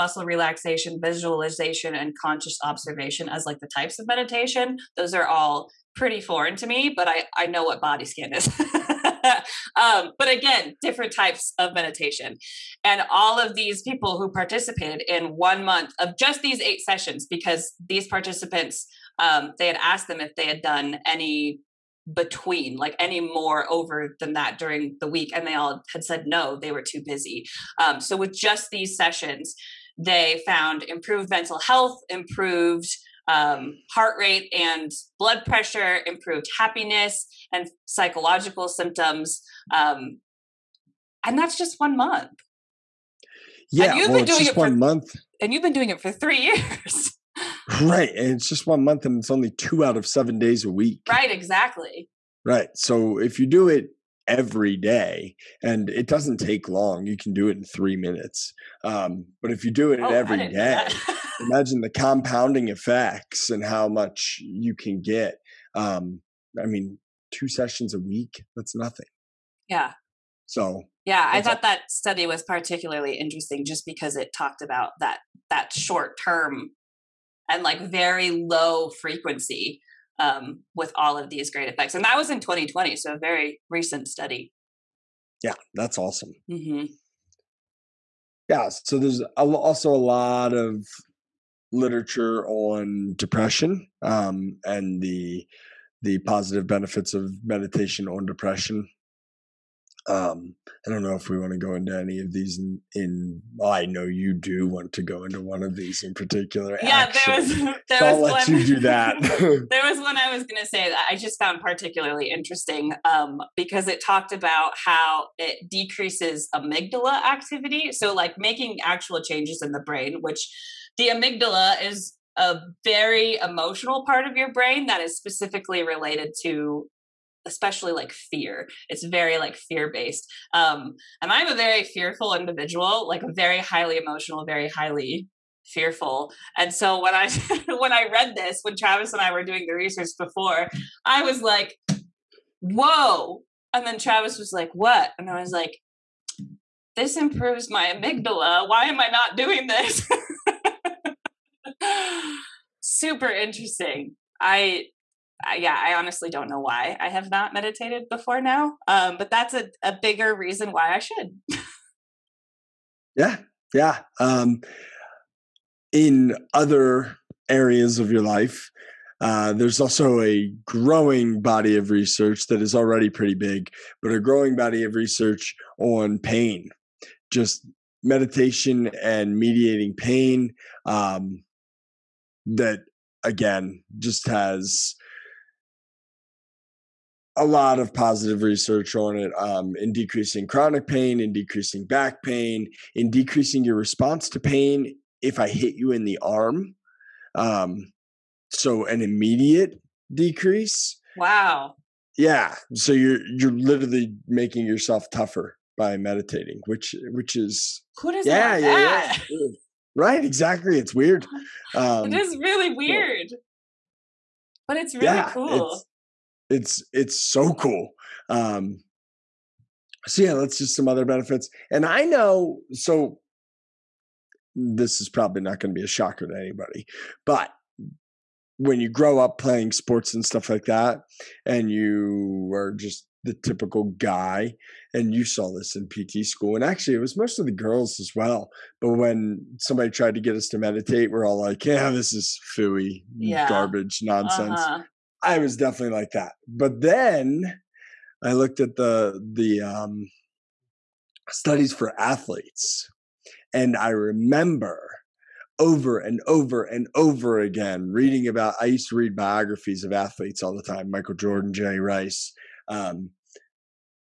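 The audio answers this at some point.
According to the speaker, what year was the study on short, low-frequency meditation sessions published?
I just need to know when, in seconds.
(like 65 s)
82 s.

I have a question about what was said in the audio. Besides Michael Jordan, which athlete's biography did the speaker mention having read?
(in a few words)
Jerry Rice.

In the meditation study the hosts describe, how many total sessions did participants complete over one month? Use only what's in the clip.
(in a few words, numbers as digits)
8.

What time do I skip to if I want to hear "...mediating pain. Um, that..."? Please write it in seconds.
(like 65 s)
179 s.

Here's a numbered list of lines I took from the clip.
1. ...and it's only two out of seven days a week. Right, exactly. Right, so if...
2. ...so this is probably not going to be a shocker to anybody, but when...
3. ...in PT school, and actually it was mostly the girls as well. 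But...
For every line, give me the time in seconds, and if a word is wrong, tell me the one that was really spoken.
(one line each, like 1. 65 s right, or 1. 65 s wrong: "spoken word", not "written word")
1. 49 s right
2. 222 s right
3. 235 s right.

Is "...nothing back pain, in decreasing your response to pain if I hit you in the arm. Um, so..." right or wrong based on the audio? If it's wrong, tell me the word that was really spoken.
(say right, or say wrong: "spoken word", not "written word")
wrong: "decreasing", not "nothing".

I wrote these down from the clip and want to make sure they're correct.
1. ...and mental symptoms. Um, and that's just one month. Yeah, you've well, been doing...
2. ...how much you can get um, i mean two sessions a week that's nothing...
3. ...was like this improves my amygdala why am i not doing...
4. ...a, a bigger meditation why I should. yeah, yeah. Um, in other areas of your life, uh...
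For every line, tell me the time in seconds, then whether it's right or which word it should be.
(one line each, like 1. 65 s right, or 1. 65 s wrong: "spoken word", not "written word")
1. 37 s wrong: "psychological", not "mental"
2. 63 s right
3. 145 s right
4. 159 s wrong: "reason", not "meditation".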